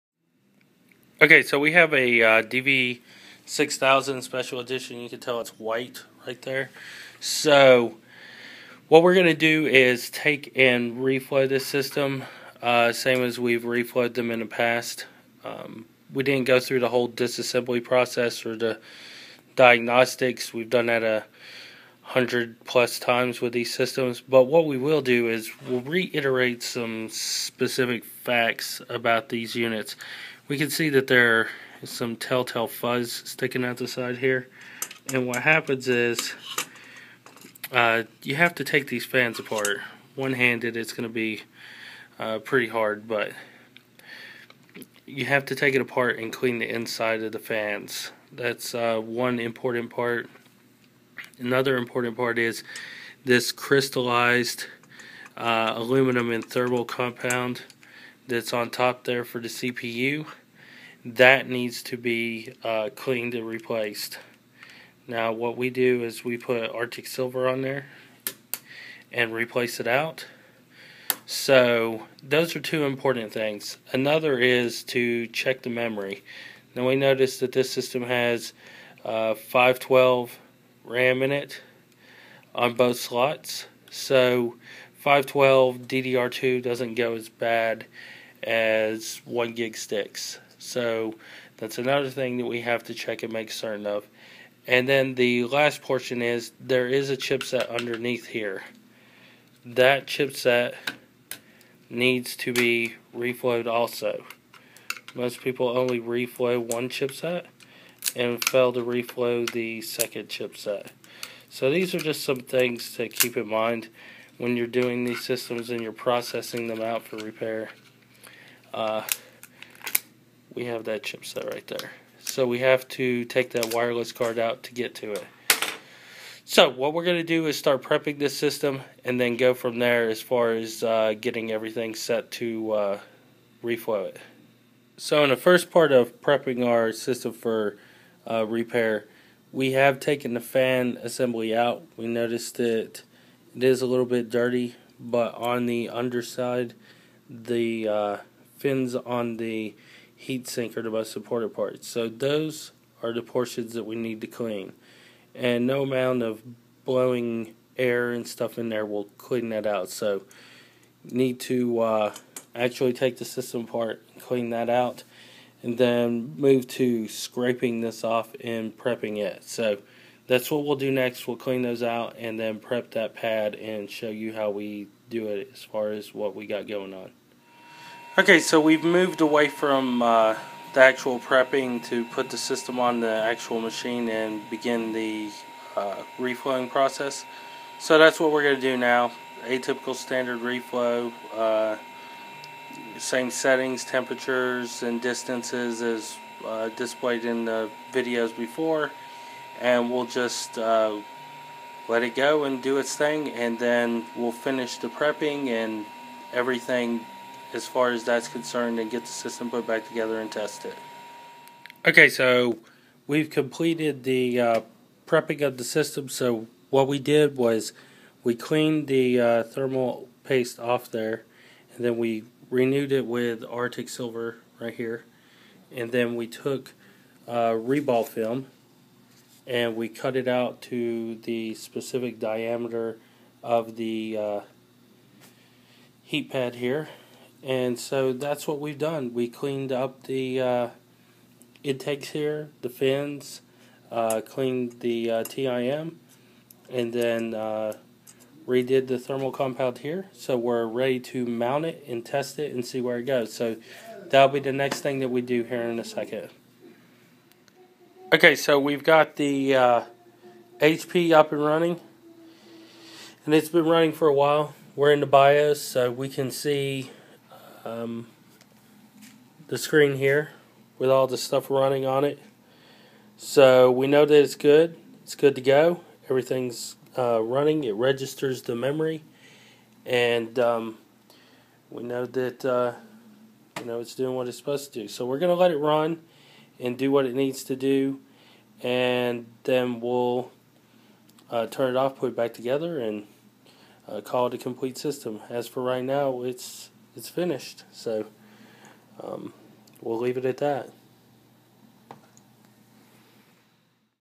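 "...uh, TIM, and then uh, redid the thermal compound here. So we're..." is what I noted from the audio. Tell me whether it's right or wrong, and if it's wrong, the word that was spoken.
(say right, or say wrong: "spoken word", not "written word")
right.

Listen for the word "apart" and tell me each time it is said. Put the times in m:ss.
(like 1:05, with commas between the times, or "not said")
0:39, 0:45, 2:43.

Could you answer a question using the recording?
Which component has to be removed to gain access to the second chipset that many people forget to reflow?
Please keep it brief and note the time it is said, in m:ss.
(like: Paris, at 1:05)
wireless card, at 2:03.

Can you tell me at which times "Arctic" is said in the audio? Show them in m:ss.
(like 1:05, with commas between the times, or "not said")
1:06, 3:43.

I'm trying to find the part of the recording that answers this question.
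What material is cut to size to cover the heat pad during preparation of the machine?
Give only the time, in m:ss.
3:47.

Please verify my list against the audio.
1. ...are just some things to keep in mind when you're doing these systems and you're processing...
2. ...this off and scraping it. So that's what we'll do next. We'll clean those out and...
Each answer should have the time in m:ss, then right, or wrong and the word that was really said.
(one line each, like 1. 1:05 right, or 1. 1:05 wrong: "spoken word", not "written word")
1. 1:51 right
2. 2:47 wrong: "prepping", not "scraping".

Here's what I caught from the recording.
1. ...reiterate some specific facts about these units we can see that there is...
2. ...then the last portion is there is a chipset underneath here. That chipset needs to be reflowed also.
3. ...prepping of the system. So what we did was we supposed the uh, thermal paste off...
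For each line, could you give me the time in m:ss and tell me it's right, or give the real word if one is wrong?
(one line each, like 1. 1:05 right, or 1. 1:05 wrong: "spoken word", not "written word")
1. 0:25 right
2. 1:34 right
3. 3:35 wrong: "cleaned", not "supposed".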